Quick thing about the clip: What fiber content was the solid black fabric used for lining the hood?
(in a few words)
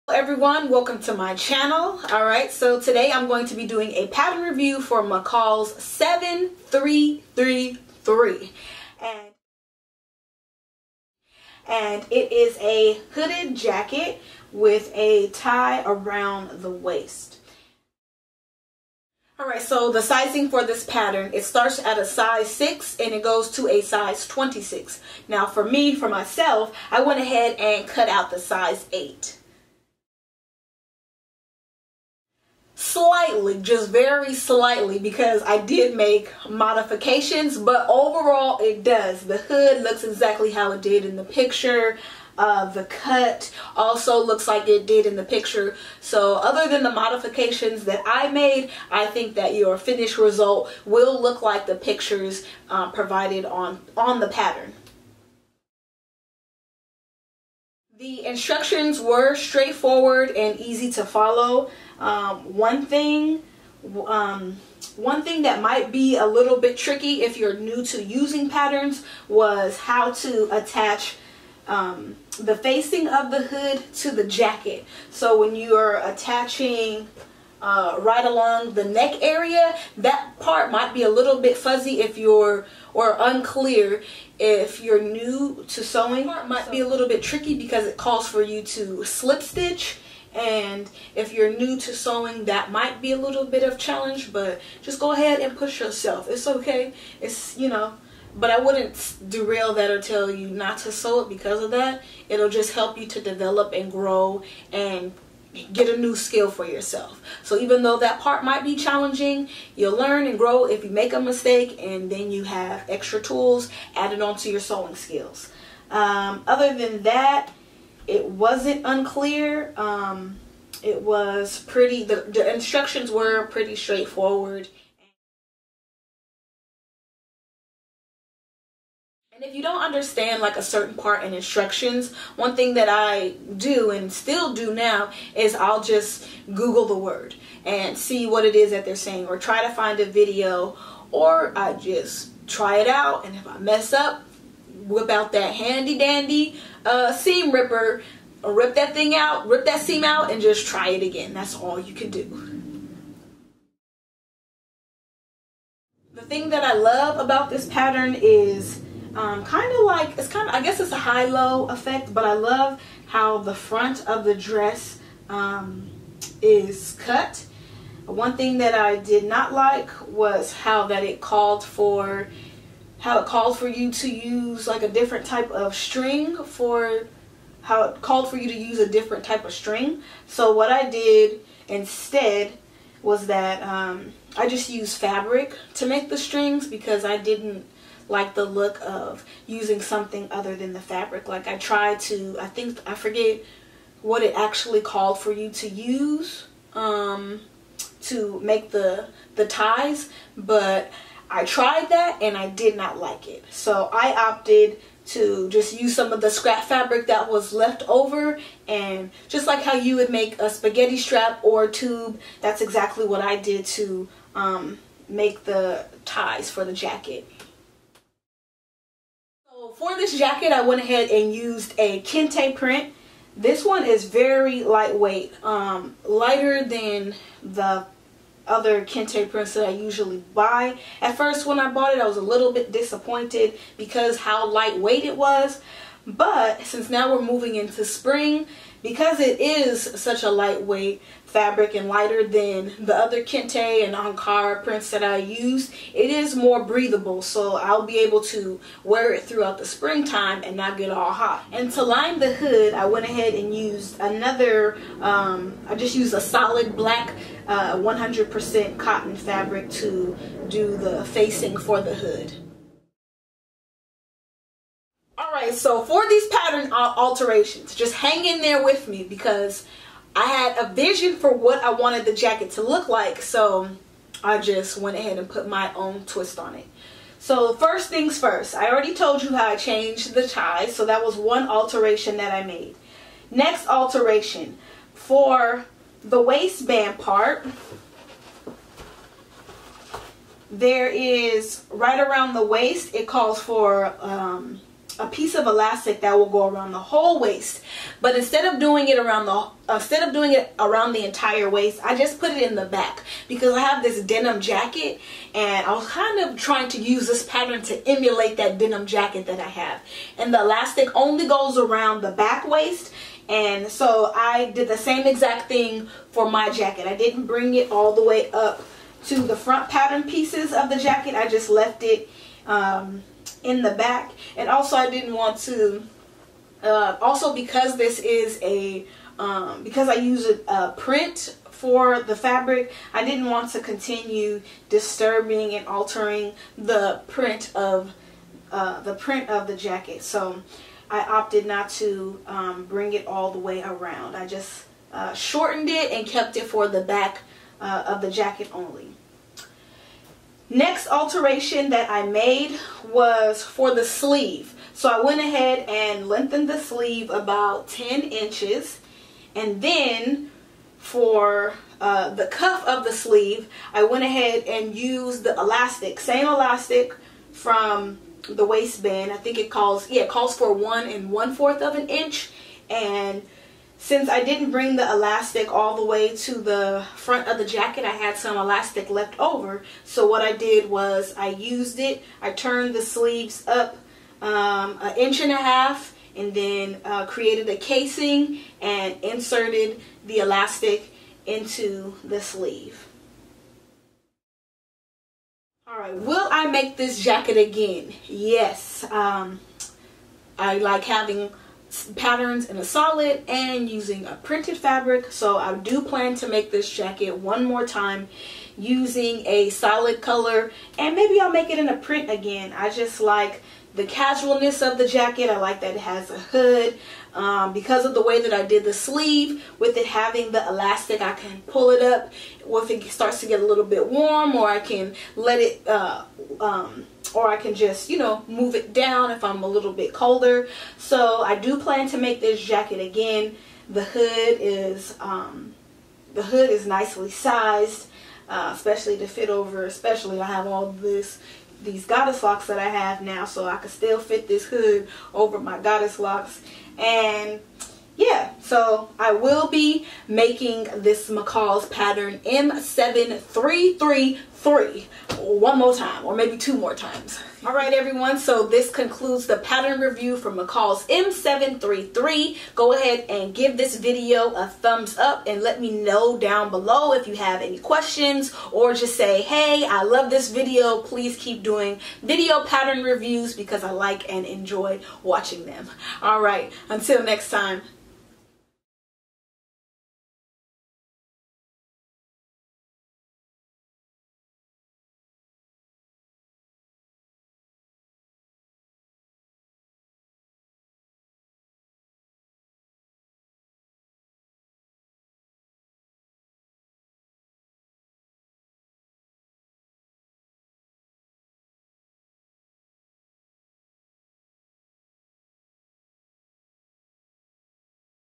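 100% cotton.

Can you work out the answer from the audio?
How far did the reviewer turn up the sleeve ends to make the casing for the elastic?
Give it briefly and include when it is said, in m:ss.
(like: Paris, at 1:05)
1.5 inches, at 6:24.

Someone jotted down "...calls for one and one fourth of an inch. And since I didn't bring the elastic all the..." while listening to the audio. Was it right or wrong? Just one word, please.
right.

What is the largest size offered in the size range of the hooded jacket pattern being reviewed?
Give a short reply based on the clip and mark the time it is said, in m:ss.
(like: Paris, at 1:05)
26, at 0:23.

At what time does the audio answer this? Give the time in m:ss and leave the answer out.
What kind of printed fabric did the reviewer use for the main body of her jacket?
3:42.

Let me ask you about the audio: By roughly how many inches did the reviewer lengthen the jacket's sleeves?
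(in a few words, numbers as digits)
10 inches.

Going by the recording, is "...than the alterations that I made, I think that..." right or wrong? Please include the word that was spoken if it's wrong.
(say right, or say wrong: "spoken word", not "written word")
wrong: "modifications", not "alterations".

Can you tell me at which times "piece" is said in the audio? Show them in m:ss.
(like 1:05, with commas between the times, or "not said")
4:55, 5:20.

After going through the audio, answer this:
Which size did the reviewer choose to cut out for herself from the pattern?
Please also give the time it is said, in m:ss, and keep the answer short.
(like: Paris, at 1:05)
8, at 0:28.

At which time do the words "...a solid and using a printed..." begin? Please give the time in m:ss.
6:42.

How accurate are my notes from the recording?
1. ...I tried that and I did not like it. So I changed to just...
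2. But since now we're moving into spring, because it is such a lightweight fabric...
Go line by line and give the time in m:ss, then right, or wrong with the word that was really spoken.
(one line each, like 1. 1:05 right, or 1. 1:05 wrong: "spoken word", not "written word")
1. 3:21 wrong: "opted", not "changed"
2. 3:56 right.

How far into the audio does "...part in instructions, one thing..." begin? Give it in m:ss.
2:10.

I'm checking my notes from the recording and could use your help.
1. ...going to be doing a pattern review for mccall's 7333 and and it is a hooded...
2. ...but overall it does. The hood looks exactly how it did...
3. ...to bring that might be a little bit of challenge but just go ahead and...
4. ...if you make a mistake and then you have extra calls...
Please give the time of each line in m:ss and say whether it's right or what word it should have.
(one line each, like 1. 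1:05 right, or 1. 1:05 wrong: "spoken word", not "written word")
1. 0:03 right
2. 0:37 right
3. 1:31 wrong: "sewing", not "bring"
4. 1:50 wrong: "tools", not "calls".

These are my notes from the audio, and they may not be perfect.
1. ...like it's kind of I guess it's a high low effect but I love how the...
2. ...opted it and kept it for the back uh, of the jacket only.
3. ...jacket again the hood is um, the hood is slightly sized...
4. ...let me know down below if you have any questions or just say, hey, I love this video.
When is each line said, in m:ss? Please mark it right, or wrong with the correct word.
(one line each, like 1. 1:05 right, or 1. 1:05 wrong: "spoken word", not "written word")
1. 2:39 right
2. 5:45 wrong: "shortened", not "opted"
3. 7:12 wrong: "nicely", not "slightly"
4. 7:45 right.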